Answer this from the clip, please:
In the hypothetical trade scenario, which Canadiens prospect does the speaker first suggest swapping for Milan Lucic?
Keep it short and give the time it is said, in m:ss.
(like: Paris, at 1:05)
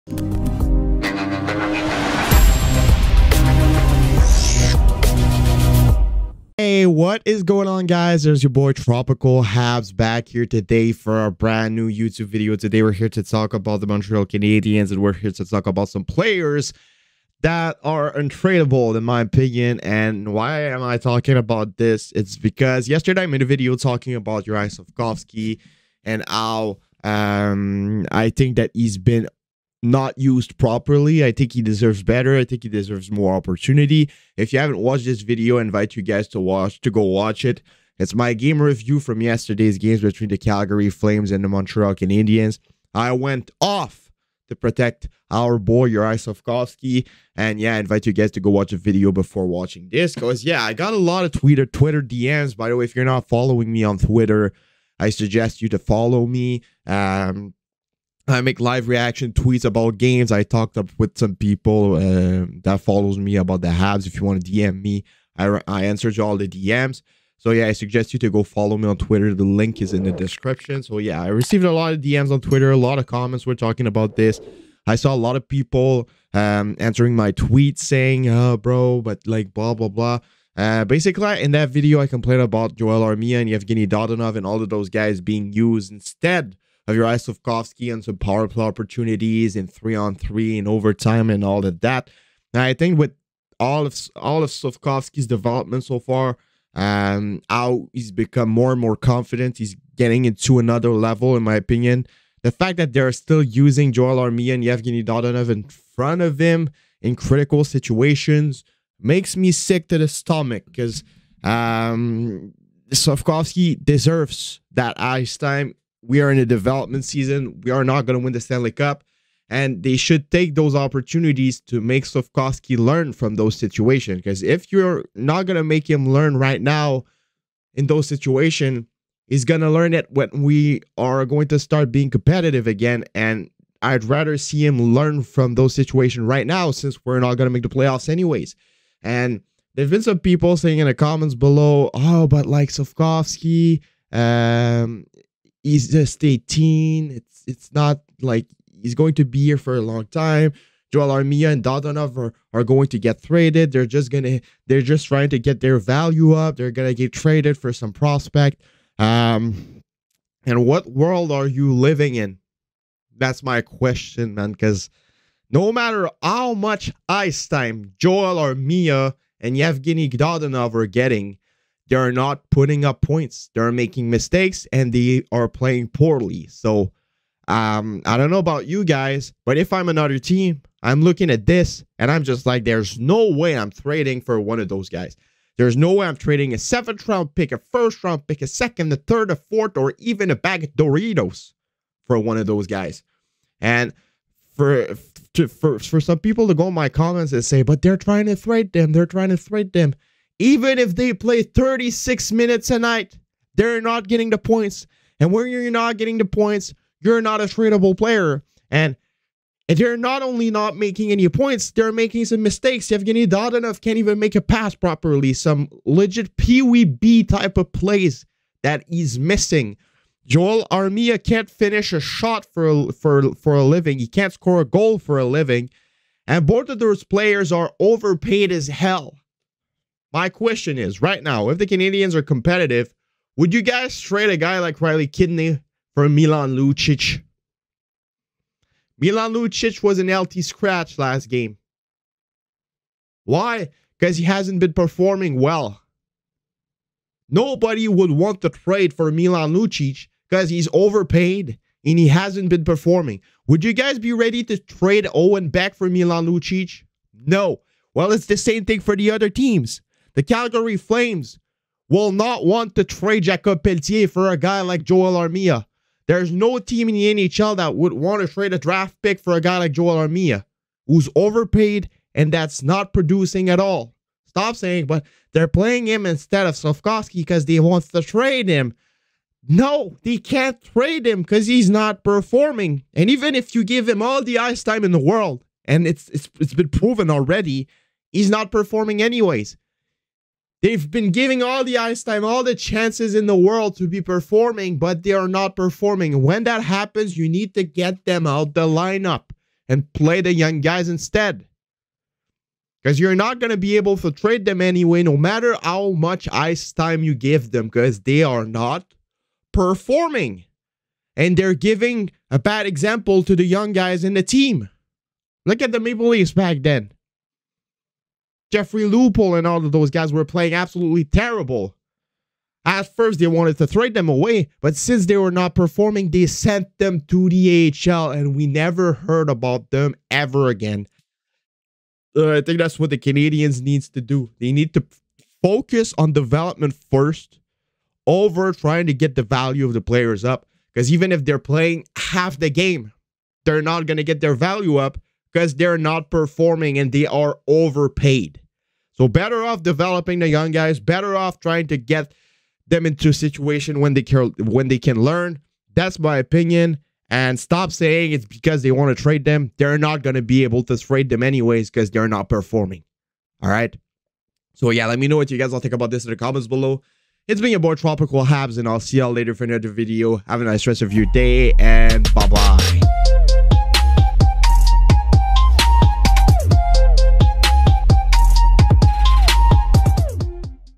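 Riley Kidney, at 3:54.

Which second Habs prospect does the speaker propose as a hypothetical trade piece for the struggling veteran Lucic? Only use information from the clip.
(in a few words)
Owen Beck.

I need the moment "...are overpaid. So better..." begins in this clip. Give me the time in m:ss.
5:47.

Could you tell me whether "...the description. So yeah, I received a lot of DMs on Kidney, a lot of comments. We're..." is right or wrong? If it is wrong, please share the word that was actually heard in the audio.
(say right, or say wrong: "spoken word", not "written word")
wrong: "Twitter", not "Kidney".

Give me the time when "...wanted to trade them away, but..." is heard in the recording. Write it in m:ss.
5:23.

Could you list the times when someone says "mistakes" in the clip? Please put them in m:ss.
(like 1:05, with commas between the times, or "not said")
2:54, 3:32.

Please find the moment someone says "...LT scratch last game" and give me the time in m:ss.
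4:00.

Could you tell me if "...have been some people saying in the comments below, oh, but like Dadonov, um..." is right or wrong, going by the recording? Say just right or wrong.
wrong.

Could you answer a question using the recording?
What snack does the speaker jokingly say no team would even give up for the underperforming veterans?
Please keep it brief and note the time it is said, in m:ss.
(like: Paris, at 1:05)
bag of Doritos, at 3:10.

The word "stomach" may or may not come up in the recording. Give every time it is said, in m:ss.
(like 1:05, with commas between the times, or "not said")
1:50.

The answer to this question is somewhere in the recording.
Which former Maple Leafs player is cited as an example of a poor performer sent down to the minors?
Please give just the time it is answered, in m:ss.
5:18.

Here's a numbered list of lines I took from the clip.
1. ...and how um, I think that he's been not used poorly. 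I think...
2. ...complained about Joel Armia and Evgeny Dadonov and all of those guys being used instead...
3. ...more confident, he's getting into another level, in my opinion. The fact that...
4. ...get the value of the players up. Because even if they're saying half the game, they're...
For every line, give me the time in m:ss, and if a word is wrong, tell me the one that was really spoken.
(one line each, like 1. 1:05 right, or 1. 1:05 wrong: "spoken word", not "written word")
1. 0:26 wrong: "properly", not "poorly"
2. 1:22 right
3. 1:38 right
4. 5:38 wrong: "playing", not "saying".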